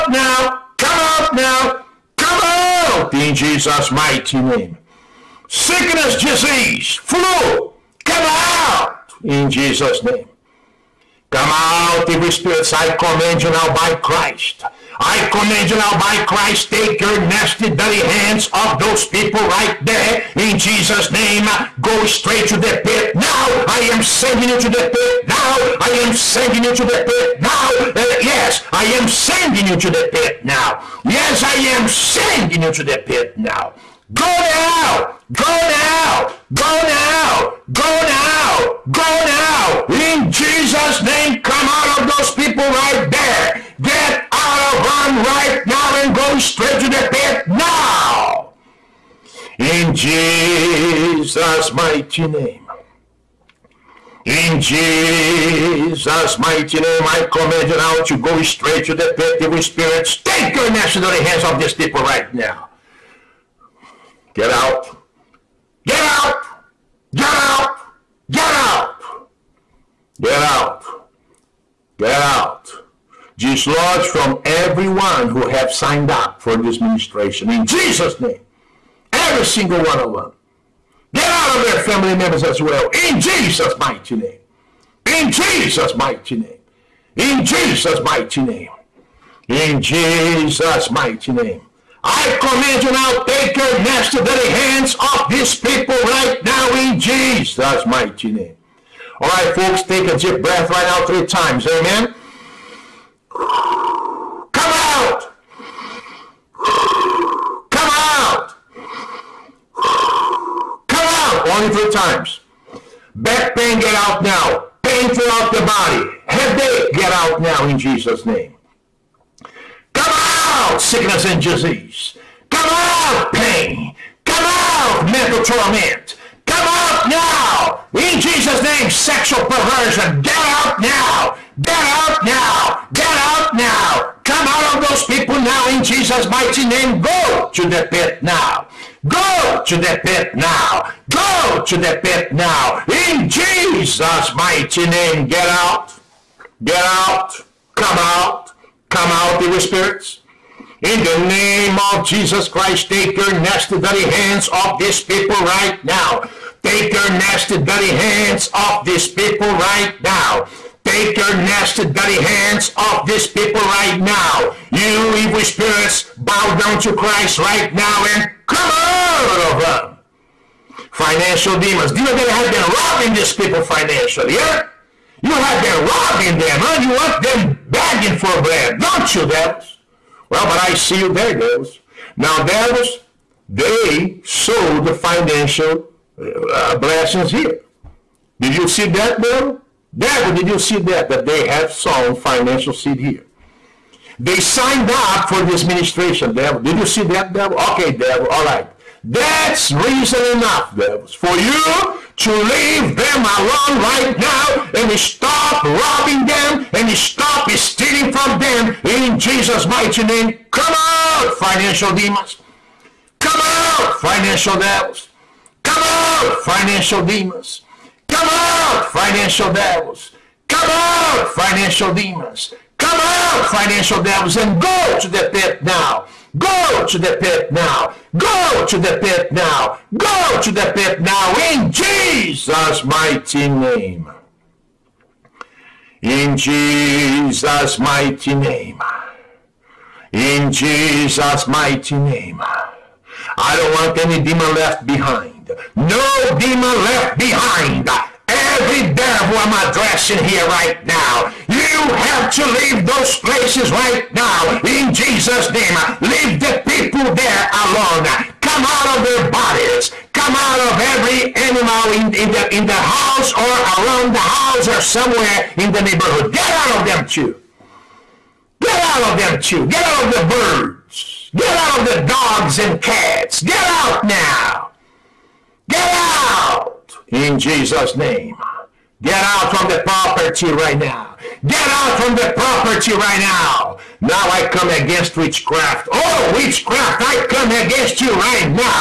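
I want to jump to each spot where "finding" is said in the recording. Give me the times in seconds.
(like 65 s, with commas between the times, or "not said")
not said.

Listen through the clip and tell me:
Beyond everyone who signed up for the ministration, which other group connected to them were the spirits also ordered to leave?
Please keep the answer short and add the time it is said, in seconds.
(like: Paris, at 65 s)
family members, at 81 s.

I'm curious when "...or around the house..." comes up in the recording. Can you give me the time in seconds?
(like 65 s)
263 s.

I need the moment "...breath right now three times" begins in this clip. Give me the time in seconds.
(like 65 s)
100 s.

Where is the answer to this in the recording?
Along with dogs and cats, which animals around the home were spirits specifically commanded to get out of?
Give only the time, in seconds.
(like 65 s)
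270 s.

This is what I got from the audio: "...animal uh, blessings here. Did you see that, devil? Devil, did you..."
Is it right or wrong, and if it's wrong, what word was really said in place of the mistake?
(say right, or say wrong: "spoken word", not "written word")
wrong: "financial", not "animal".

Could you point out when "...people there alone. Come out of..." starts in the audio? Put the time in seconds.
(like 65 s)
256 s.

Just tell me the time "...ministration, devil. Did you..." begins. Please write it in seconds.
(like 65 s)
195 s.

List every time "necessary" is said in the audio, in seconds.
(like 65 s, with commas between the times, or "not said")
60 s.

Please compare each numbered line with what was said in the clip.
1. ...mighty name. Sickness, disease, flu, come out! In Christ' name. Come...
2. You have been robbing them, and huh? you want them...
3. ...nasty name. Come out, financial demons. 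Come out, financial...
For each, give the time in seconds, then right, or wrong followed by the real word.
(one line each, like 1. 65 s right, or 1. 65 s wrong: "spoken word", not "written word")
1. 3 s wrong: "Jesus", not "Christ"
2. 175 s right
3. 209 s wrong: "mighty", not "nasty".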